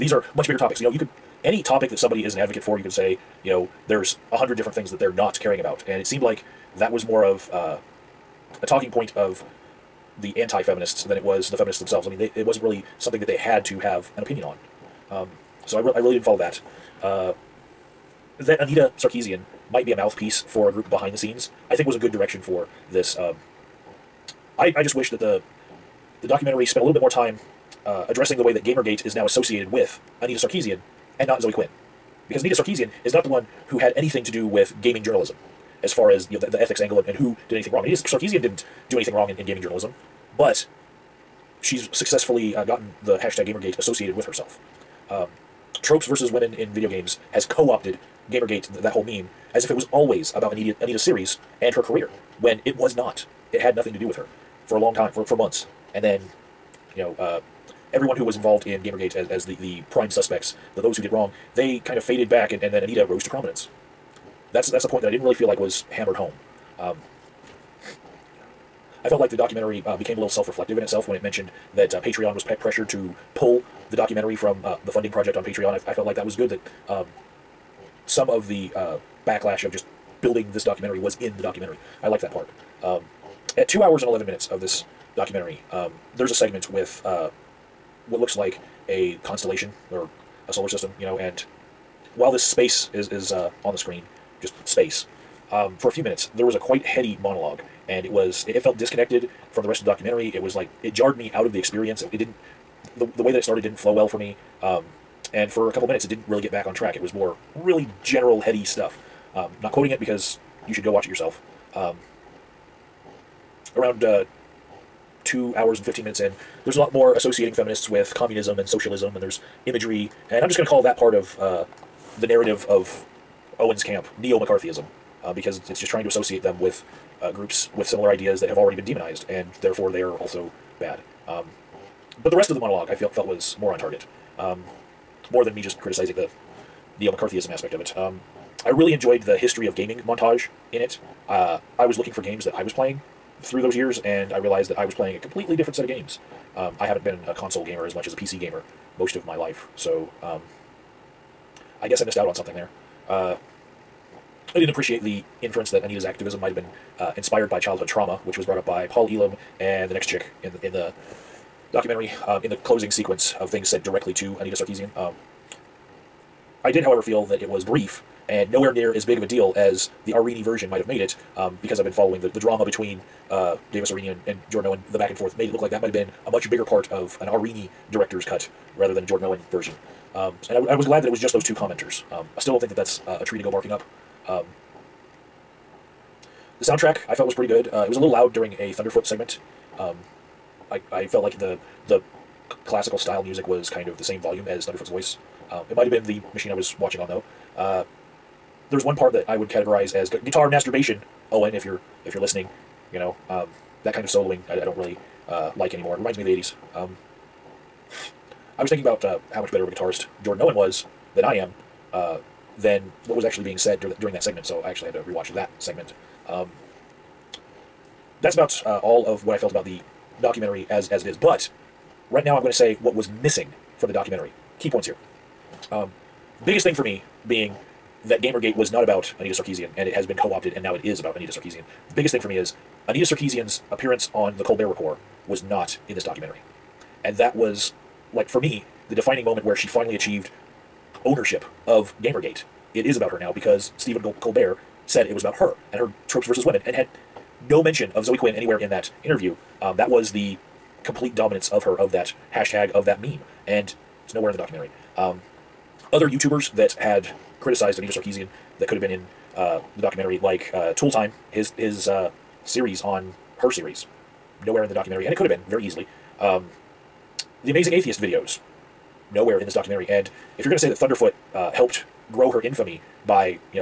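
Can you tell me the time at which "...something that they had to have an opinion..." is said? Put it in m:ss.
0:12.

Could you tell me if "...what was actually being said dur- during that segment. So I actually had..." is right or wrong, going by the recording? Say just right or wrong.
right.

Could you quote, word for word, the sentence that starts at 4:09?
Um, that was the complete dominance of her, of that hashtag, of that meme.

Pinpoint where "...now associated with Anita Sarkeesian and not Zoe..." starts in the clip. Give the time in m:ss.
0:29.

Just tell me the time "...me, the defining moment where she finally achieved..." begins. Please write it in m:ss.
3:58.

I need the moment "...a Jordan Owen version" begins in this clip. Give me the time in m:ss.
2:59.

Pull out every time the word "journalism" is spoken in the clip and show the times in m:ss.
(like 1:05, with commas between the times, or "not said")
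0:35, 0:39.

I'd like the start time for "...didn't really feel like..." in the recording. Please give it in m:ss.
1:05.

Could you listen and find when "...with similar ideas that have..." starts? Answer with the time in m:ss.
2:07.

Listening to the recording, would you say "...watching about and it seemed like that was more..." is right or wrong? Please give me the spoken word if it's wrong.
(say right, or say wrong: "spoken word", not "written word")
wrong: "caring", not "watching".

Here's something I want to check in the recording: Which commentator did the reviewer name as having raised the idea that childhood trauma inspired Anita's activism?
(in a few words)
Paul Elam.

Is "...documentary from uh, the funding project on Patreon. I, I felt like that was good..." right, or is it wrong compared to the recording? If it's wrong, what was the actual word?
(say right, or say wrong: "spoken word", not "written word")
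right.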